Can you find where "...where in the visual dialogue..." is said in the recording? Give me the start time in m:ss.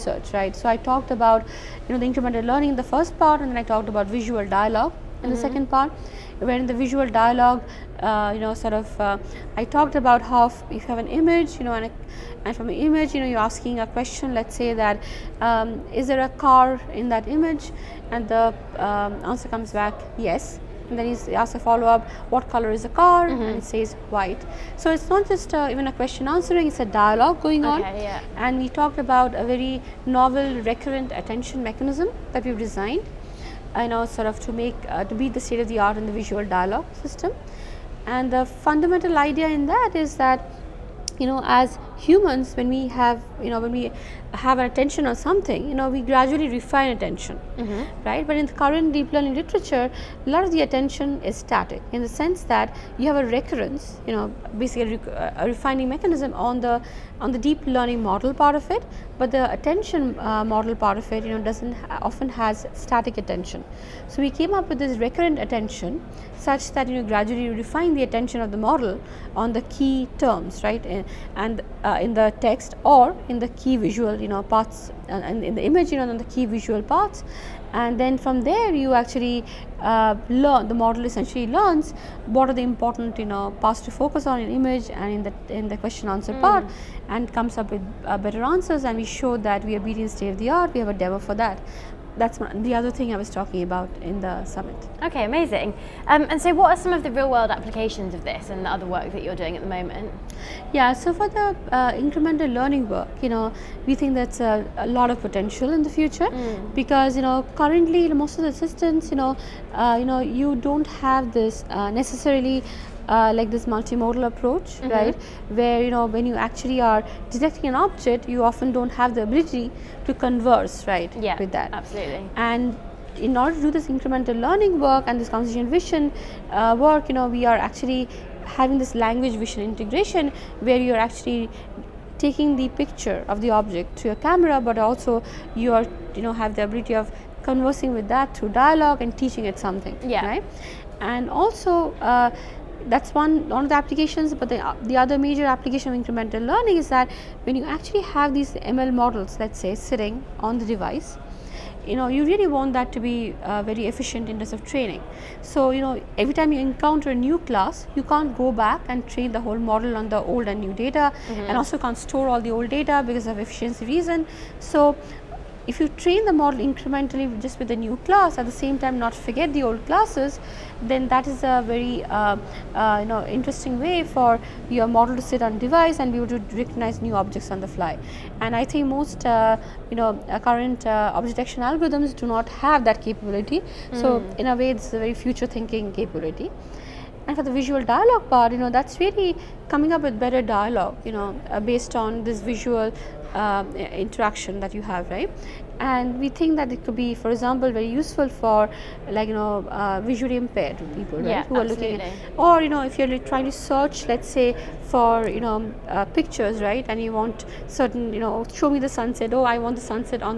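0:06.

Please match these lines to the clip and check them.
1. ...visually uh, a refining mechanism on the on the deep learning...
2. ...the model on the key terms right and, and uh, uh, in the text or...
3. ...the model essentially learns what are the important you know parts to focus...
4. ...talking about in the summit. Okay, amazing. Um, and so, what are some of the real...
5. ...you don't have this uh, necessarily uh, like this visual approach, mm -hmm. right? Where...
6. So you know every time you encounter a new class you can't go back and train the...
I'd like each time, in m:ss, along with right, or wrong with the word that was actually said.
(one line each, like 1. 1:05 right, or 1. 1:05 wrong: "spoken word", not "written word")
1. 0:54 wrong: "basically", not "visually"
2. 1:08 right
3. 1:20 right
4. 1:33 right
5. 1:50 wrong: "multimodal", not "visual"
6. 2:35 right.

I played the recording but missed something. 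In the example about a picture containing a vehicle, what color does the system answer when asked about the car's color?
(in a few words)
white.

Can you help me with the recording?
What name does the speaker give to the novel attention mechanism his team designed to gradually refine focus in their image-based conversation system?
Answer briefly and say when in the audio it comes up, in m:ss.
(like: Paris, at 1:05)
recurrent attention mechanism, at 0:30.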